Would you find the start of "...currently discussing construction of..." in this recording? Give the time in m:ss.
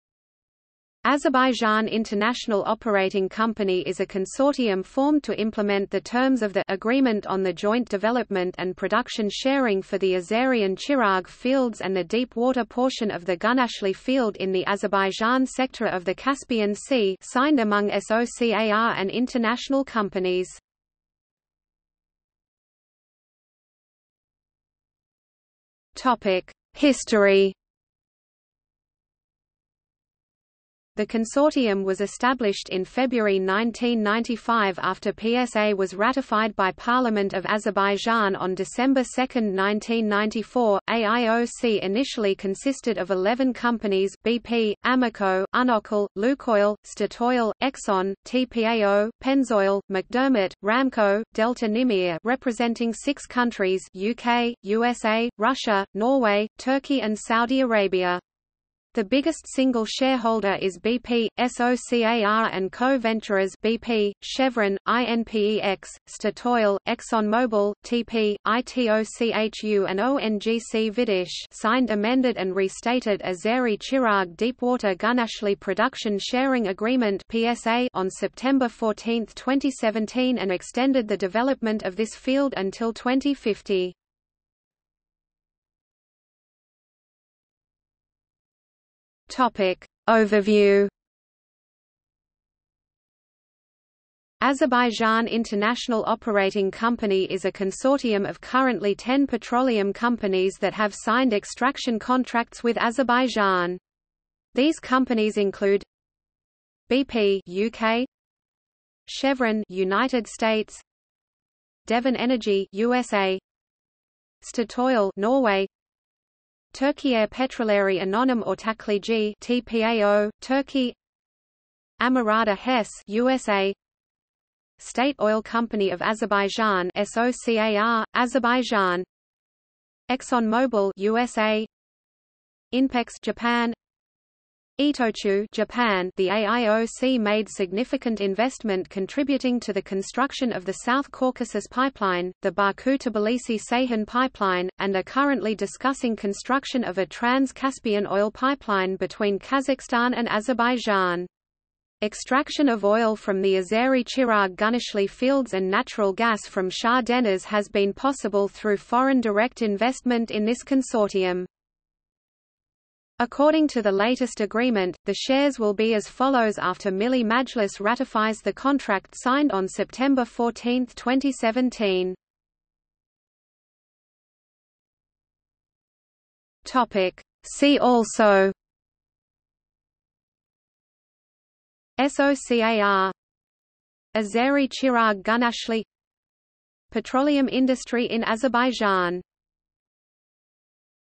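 2:25.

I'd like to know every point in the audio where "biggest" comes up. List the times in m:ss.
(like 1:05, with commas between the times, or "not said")
0:59.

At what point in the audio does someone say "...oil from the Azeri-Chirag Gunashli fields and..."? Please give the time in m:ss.
2:32.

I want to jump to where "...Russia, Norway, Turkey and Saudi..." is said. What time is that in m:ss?
0:55.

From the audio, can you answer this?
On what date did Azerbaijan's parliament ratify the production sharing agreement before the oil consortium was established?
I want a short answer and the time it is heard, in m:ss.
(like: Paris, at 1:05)
December 2, 1994, at 0:38.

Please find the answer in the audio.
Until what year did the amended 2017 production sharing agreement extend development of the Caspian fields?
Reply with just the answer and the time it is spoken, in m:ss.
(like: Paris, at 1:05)
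2050, at 1:22.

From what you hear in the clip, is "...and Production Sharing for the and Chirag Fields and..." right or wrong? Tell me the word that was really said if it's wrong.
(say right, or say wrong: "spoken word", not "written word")
right.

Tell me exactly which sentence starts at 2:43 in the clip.
According to the latest agreement, the shares will be as follows after Milli Majlis ratifies the contract signed on September 14, 2017.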